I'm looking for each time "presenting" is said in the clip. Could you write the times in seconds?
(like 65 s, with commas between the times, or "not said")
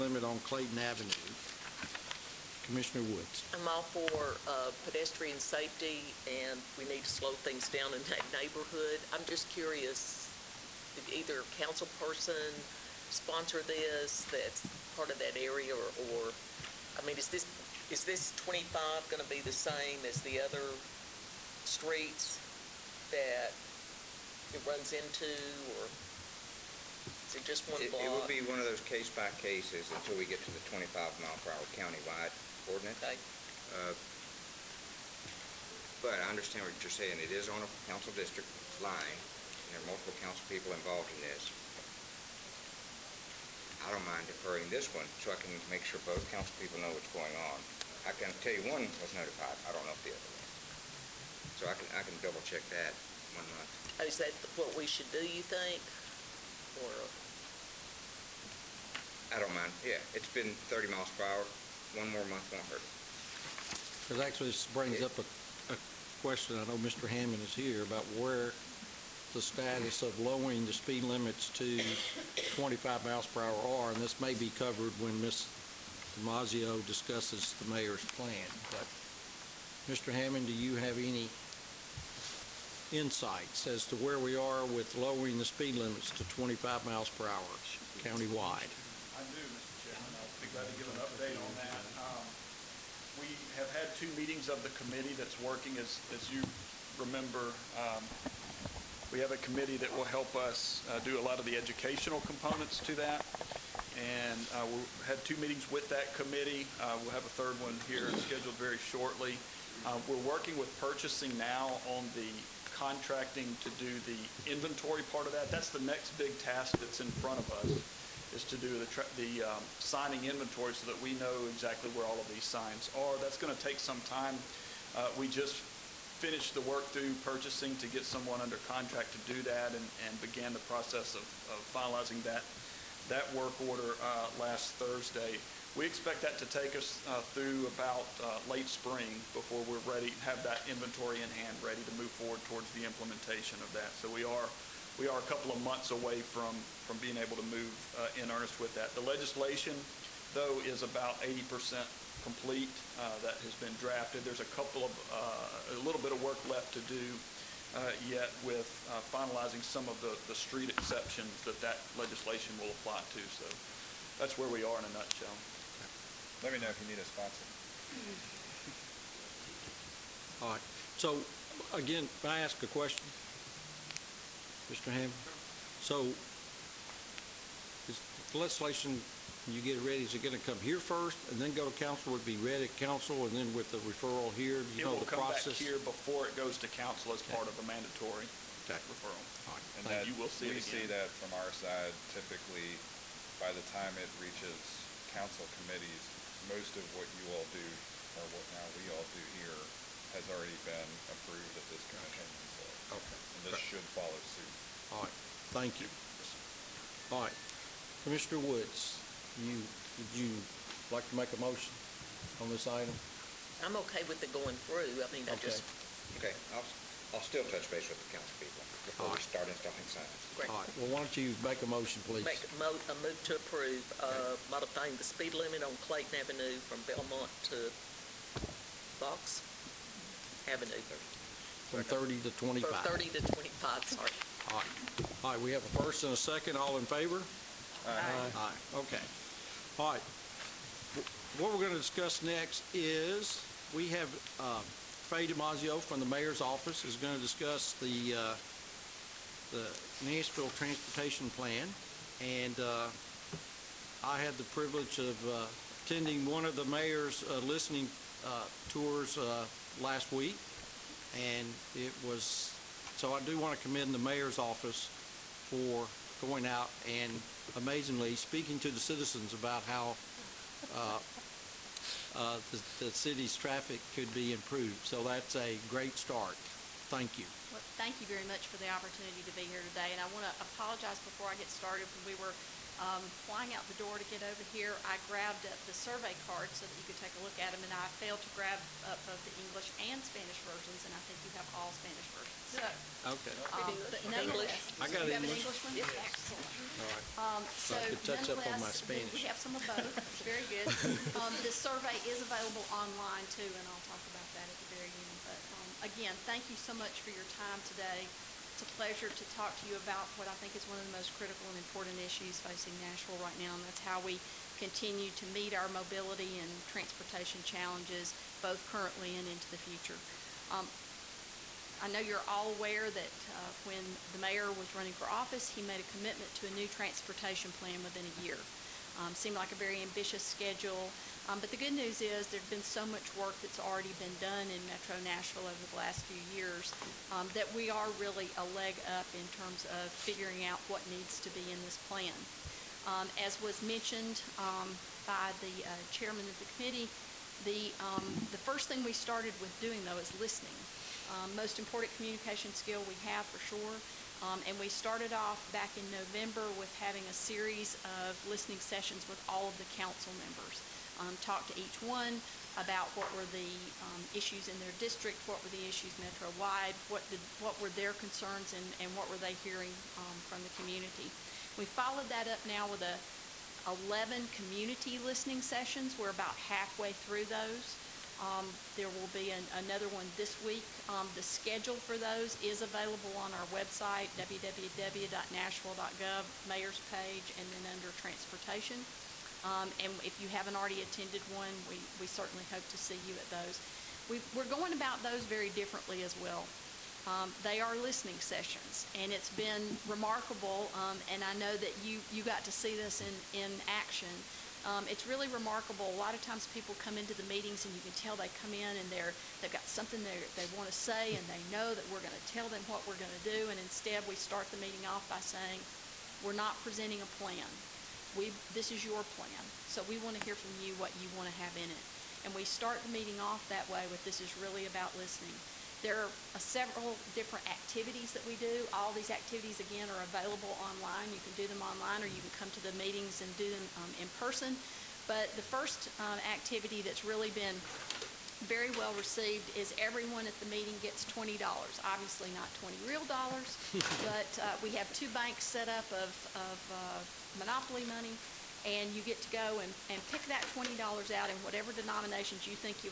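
416 s.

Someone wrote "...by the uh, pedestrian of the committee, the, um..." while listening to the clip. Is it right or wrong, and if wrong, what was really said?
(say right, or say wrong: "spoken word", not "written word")
wrong: "chairman", not "pedestrian".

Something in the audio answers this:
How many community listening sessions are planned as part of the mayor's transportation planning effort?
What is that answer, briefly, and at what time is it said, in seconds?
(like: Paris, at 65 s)
11, at 373 s.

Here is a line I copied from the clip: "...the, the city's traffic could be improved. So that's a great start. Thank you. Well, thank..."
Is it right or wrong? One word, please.
right.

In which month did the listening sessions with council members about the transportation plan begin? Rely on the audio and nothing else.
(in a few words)
November.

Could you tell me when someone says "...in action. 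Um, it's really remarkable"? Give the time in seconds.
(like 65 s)
403 s.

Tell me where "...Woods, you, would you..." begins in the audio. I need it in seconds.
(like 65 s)
208 s.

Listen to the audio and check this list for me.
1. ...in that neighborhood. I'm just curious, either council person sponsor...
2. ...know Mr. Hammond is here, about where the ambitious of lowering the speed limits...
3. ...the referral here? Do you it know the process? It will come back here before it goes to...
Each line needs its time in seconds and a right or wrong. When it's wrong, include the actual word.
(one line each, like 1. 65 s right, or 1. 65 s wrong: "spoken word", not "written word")
1. 7 s right
2. 66 s wrong: "status", not "ambitious"
3. 183 s right.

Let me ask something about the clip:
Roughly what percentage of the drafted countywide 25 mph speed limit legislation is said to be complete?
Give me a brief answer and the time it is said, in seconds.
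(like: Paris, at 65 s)
80%, at 151 s.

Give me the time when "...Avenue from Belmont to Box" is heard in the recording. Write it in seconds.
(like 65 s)
226 s.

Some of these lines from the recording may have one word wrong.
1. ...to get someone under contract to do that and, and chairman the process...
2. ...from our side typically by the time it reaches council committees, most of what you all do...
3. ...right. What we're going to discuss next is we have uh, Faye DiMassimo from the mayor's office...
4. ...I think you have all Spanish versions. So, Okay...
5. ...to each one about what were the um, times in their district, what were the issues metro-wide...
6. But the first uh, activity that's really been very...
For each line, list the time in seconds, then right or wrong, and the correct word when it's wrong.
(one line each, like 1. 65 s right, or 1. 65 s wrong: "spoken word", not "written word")
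1. 127 s wrong: "began", not "chairman"
2. 191 s right
3. 239 s right
4. 290 s right
5. 361 s wrong: "issues", not "times"
6. 435 s right.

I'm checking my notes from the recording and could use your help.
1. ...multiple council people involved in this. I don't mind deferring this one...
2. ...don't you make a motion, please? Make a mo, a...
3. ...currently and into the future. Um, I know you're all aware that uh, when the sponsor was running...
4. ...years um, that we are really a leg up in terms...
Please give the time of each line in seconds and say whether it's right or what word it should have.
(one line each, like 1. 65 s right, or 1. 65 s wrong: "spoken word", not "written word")
1. 39 s right
2. 220 s right
3. 318 s wrong: "mayor", not "sponsor"
4. 336 s right.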